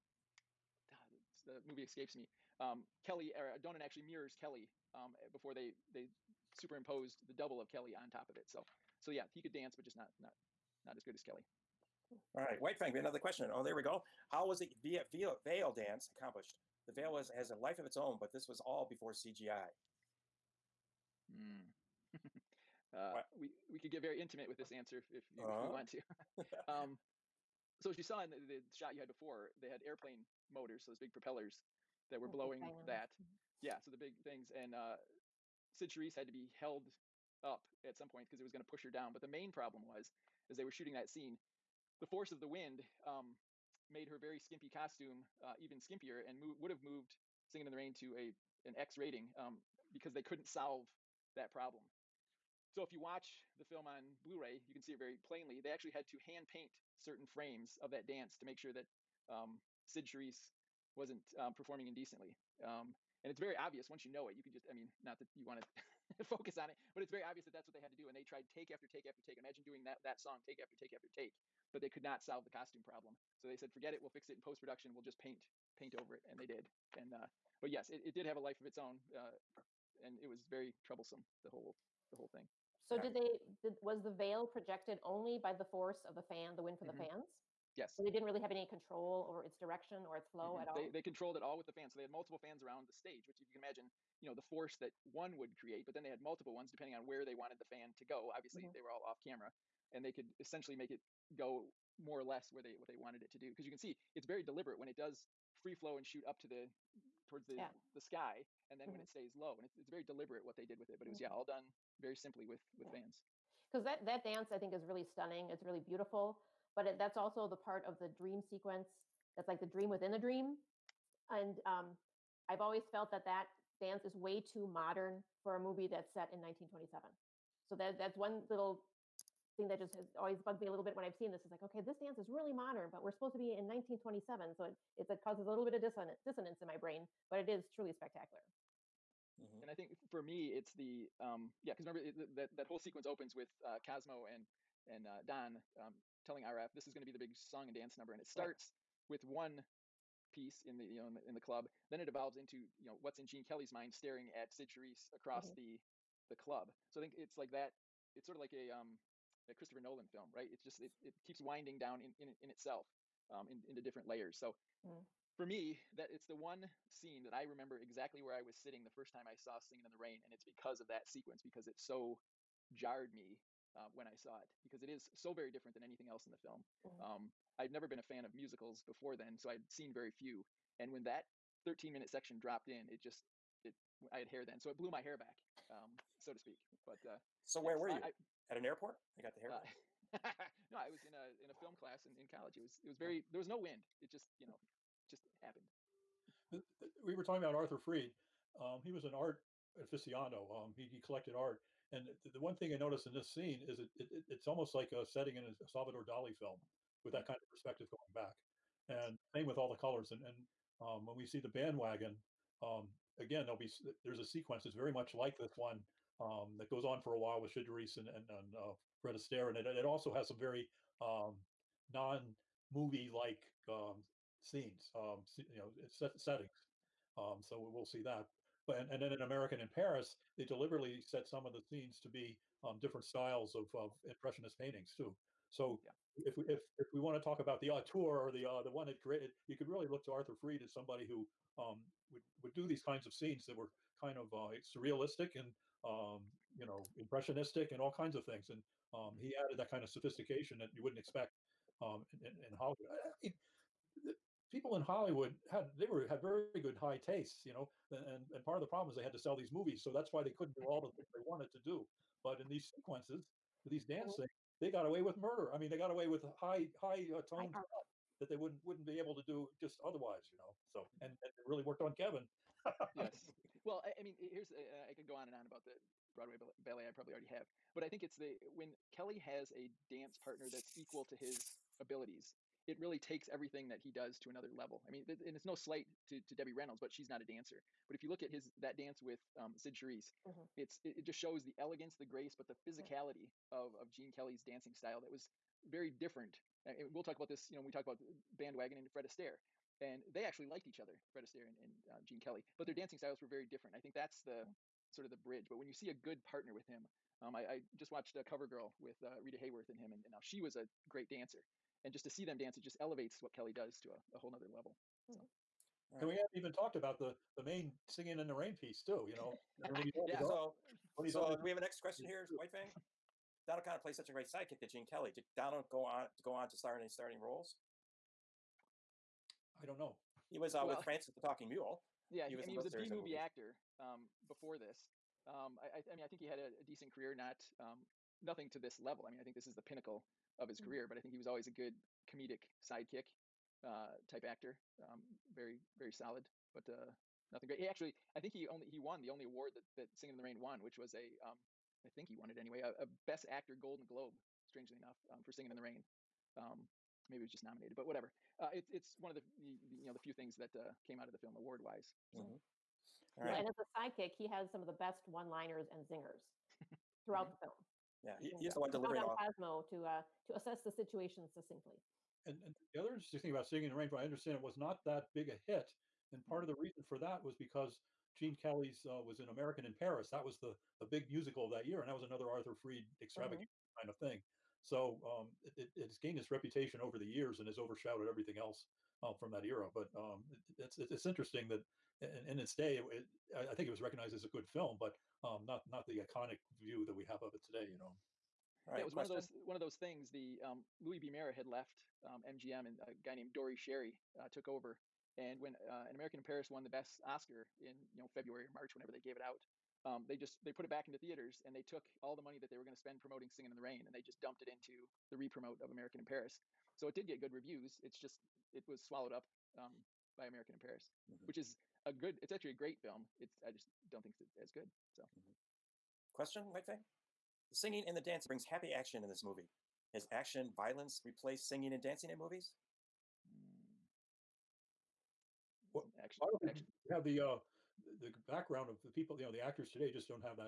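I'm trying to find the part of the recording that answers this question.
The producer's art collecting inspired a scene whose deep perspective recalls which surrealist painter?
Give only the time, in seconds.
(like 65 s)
205 s.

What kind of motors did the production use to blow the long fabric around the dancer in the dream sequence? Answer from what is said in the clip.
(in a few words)
Airplane motors.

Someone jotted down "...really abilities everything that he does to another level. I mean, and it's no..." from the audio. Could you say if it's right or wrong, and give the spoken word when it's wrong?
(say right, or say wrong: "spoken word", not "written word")
wrong: "takes", not "abilities".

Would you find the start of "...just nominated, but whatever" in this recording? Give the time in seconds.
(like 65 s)
357 s.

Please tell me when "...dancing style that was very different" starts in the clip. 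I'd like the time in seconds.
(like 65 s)
294 s.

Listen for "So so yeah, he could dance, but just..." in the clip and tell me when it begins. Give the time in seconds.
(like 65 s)
8 s.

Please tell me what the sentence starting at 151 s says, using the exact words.
Then it evolves into you know what's in Gene Kelly's mind, staring at Cyd Charisse across mm-hmm.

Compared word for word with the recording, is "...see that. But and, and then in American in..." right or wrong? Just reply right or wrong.
right.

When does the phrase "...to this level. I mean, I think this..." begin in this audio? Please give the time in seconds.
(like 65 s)
338 s.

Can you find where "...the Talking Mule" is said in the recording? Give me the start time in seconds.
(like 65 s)
331 s.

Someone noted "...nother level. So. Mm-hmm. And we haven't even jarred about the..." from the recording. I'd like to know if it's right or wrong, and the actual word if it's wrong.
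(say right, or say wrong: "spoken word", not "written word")
wrong: "talked", not "jarred".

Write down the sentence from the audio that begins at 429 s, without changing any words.
Has action, violence replaced singing and dancing in movies?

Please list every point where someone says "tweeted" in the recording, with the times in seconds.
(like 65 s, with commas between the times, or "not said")
not said.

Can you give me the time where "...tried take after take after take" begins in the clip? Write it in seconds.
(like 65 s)
68 s.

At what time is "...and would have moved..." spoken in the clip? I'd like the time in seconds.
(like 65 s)
46 s.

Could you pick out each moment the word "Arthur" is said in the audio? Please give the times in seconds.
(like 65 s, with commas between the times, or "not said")
197 s, 240 s, 382 s.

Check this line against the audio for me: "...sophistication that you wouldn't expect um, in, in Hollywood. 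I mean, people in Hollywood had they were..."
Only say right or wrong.
right.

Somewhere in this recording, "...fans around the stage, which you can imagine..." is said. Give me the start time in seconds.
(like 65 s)
92 s.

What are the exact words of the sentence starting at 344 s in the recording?
Um, very very solid, but uh, nothing great.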